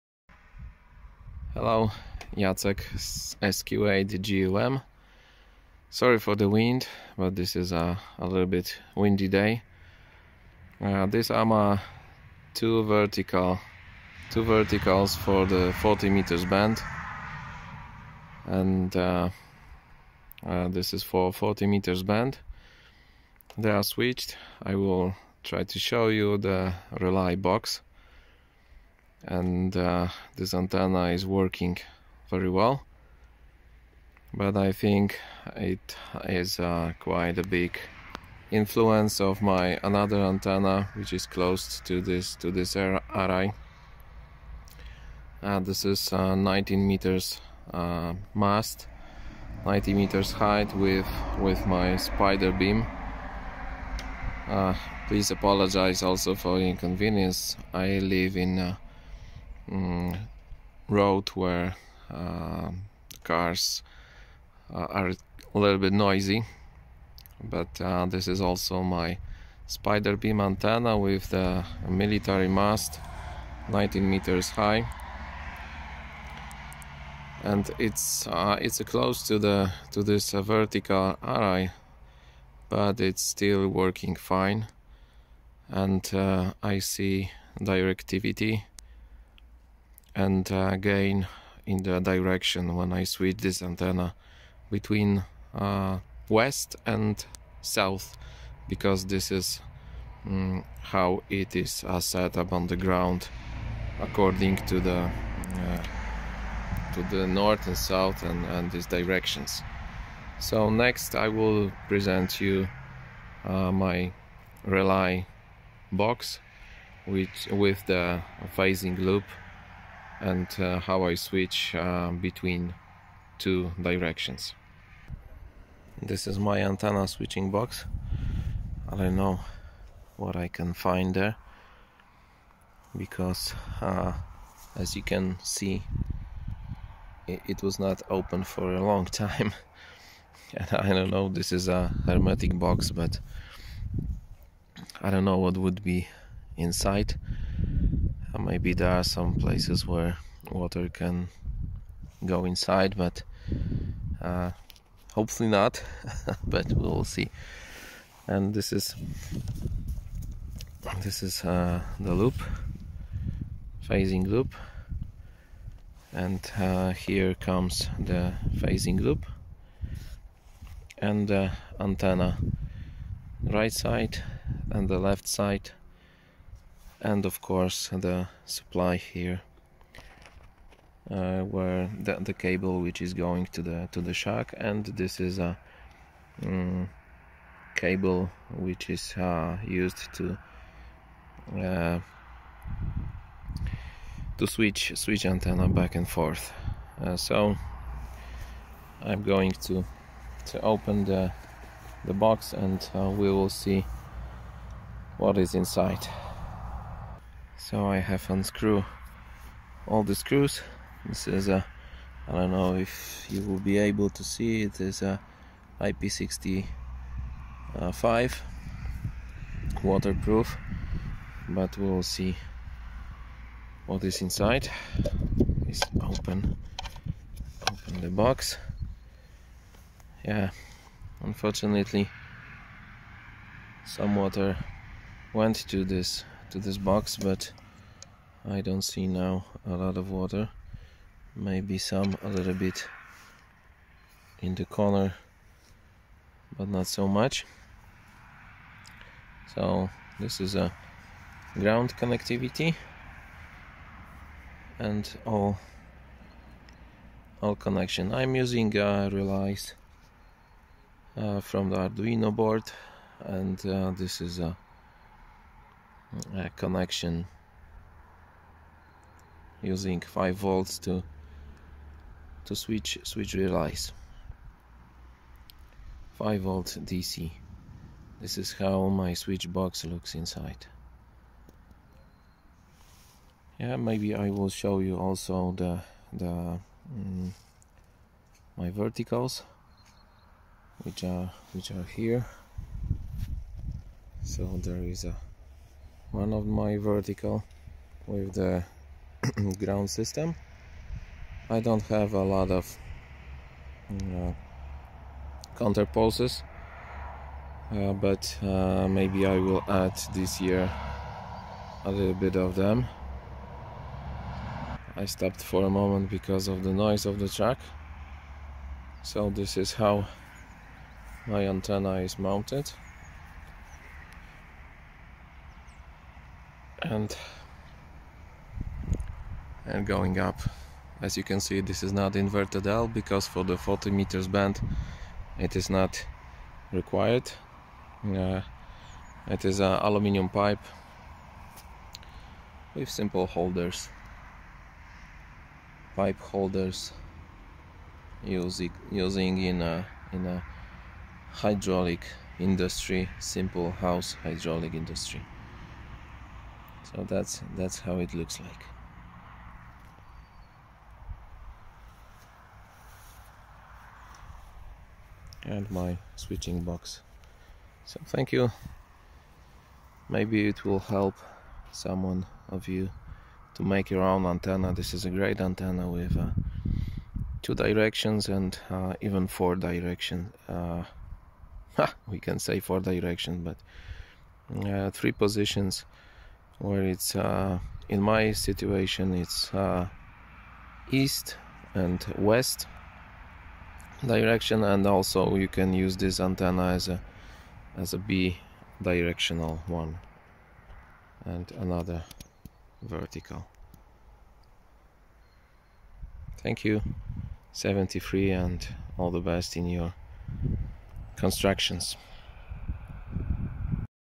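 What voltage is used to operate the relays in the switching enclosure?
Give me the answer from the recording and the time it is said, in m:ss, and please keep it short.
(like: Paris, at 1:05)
5 volts DC, at 4:36.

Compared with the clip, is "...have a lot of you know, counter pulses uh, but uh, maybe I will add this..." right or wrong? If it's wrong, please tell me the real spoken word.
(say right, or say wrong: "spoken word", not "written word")
right.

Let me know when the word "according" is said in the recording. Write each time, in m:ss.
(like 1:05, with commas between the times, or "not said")
1:44.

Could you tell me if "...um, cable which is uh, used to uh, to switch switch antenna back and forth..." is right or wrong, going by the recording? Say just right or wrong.
right.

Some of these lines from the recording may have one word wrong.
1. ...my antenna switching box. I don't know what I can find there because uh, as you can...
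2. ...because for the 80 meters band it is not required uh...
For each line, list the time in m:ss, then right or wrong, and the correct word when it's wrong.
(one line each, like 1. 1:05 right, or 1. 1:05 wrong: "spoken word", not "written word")
1. 2:06 right
2. 5:32 wrong: "40", not "80".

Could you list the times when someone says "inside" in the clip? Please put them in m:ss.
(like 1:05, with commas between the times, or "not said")
2:26, 2:32, 3:25, 3:44, 4:40.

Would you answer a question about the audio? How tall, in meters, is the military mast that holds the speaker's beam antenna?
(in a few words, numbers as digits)
19.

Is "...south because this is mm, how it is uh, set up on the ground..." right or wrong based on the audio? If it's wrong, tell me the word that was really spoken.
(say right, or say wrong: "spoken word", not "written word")
right.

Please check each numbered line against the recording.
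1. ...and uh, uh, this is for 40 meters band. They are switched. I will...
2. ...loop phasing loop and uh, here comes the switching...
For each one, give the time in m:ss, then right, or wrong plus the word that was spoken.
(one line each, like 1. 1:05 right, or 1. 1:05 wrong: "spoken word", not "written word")
1. 0:18 right
2. 2:42 wrong: "phasing", not "switching".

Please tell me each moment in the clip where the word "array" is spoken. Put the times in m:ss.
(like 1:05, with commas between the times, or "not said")
0:42, 1:21.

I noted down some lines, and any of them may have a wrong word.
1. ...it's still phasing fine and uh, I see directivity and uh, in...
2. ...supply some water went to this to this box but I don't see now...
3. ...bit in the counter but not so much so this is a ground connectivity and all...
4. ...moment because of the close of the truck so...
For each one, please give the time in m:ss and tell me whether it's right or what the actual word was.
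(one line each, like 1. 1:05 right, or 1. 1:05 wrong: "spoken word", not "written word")
1. 1:23 wrong: "working", not "phasing"
2. 3:51 wrong: "unfortunately", not "supply"
3. 4:02 wrong: "corner", not "counter"
4. 5:15 wrong: "noise", not "close".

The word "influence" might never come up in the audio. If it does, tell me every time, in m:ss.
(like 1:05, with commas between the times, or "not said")
0:38.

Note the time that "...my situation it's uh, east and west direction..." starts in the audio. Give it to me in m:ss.
6:27.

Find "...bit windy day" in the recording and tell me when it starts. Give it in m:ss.
0:08.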